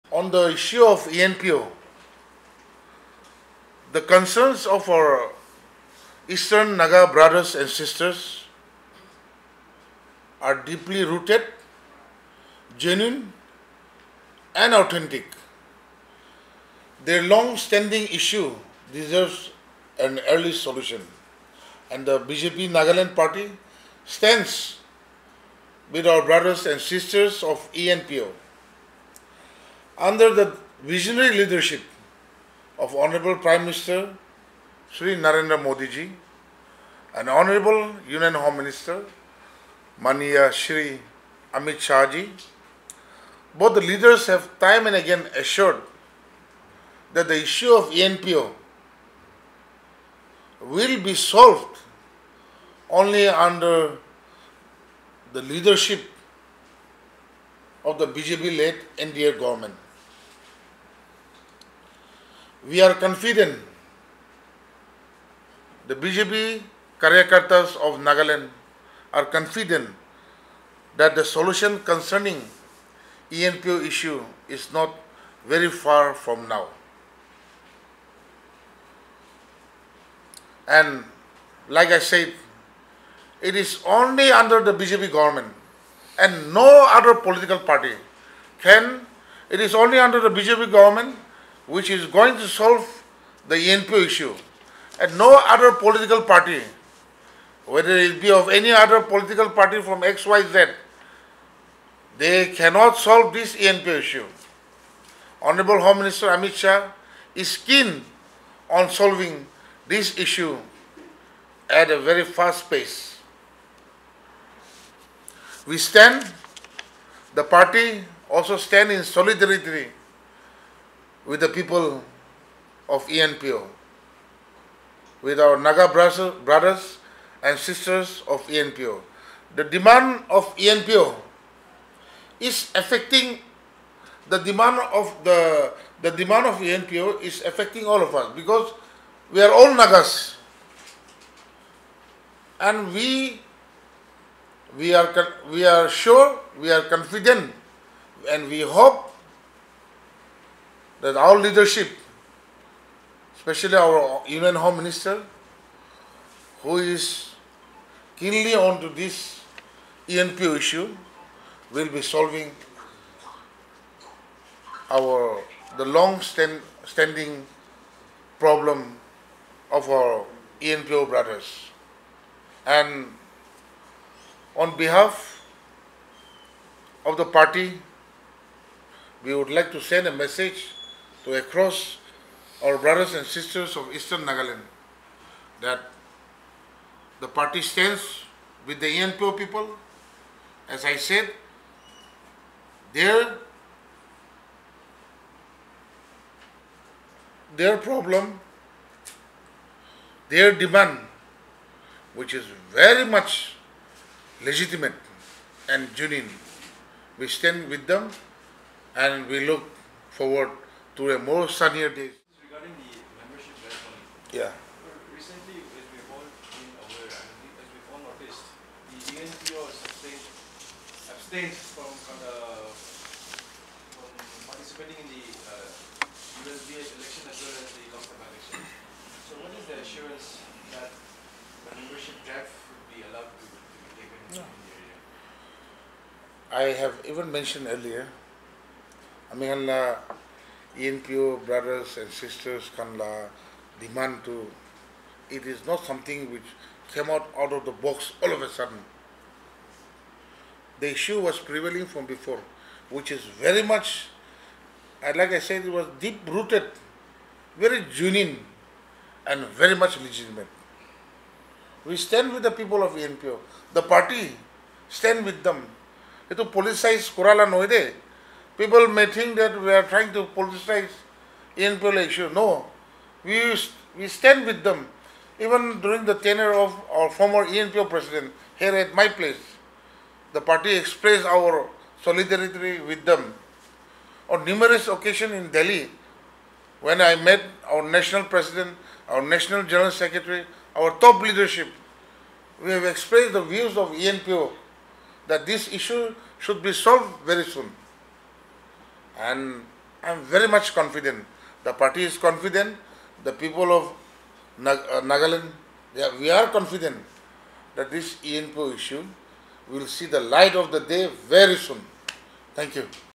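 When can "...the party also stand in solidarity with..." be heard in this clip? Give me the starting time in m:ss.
1:57.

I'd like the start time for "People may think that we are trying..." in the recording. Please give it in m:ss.
4:28.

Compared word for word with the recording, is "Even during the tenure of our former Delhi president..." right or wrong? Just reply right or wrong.
wrong.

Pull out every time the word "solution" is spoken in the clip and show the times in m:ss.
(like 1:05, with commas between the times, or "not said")
0:20, 1:11.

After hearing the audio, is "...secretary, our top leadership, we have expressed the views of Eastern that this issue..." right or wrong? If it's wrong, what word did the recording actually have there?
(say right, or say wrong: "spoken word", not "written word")
wrong: "ENPO", not "Eastern".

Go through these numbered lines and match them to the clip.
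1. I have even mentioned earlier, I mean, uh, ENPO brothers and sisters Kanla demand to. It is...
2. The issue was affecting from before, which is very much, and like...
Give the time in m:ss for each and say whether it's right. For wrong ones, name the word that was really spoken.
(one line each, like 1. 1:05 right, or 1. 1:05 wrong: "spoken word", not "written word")
1. 3:56 right
2. 4:10 wrong: "prevailing", not "affecting".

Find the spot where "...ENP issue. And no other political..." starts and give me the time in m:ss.
1:33.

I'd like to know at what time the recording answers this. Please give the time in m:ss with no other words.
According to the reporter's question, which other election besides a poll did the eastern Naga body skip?
3:47.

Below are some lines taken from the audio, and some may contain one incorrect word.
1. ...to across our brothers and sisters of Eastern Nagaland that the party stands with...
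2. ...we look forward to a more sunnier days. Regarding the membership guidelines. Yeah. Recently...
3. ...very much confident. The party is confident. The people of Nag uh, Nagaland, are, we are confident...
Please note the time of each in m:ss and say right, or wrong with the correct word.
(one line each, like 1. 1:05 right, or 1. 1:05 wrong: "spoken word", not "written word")
1. 3:01 right
2. 3:29 right
3. 5:00 right.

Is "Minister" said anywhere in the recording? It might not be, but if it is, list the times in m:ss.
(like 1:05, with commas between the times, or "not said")
0:33, 0:38, 1:45, 2:34.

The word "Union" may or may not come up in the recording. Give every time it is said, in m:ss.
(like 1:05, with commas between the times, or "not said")
0:38.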